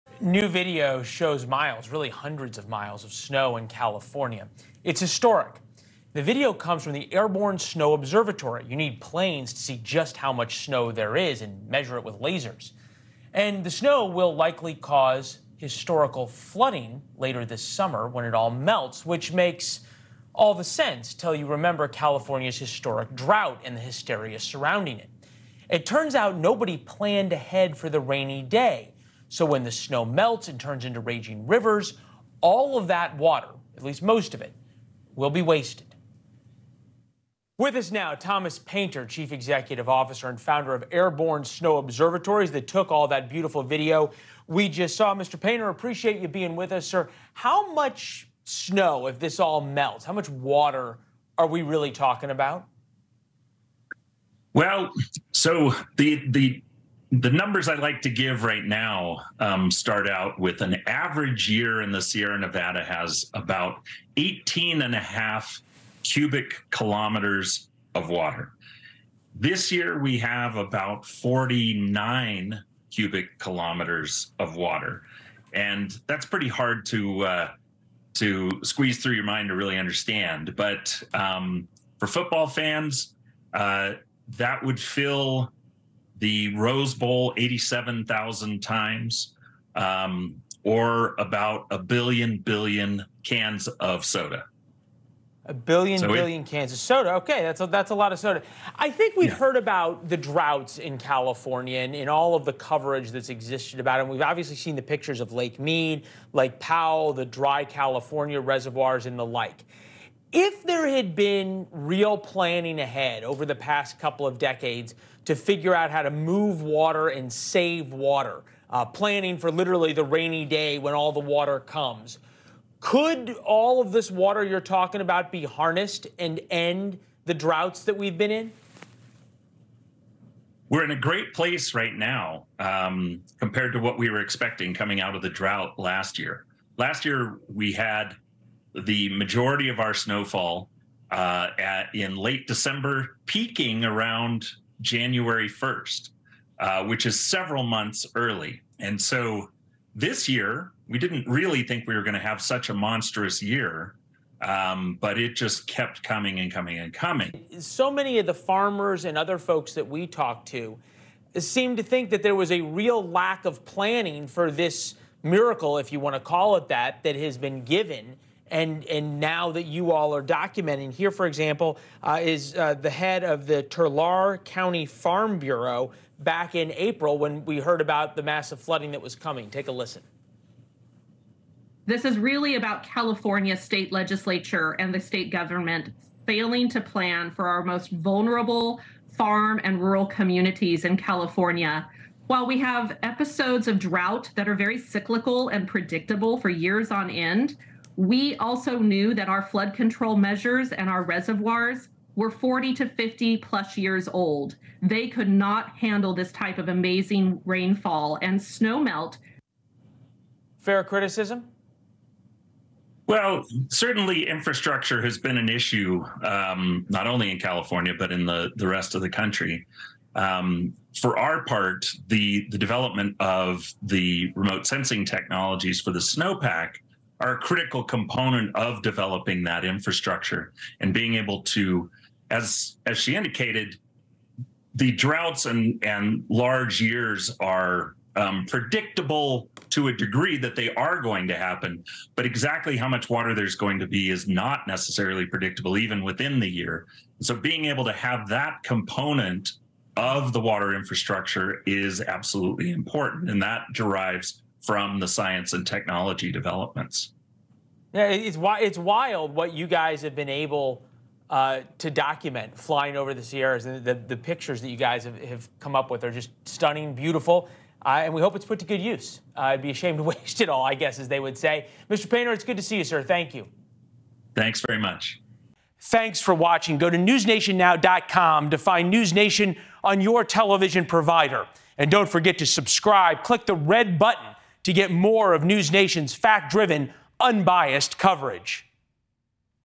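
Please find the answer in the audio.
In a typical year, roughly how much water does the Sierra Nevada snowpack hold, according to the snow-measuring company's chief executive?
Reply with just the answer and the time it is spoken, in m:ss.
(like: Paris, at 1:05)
18.5 cubic kilometers, at 1:04.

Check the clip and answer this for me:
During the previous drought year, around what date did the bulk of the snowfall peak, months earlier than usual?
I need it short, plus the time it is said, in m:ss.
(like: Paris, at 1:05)
January 1st, at 2:24.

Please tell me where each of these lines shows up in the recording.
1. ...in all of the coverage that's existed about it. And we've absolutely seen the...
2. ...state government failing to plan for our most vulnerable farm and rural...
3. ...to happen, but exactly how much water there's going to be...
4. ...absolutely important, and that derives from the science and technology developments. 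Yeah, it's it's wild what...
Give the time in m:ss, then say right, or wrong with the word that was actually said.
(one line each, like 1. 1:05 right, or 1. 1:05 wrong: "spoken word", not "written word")
1. 1:41 wrong: "obviously", not "absolutely"
2. 3:04 right
3. 4:01 right
4. 4:12 right.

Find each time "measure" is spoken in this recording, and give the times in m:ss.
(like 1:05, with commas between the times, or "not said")
0:11, 3:20.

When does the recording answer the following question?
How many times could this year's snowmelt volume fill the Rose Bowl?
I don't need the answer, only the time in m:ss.
1:27.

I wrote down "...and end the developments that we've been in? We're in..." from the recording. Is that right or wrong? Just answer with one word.
wrong.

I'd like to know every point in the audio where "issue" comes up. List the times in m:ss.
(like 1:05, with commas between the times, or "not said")
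3:35.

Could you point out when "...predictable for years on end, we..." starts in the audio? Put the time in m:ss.
3:15.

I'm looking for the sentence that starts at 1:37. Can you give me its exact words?
Okay, that's a, that's a lot of soda.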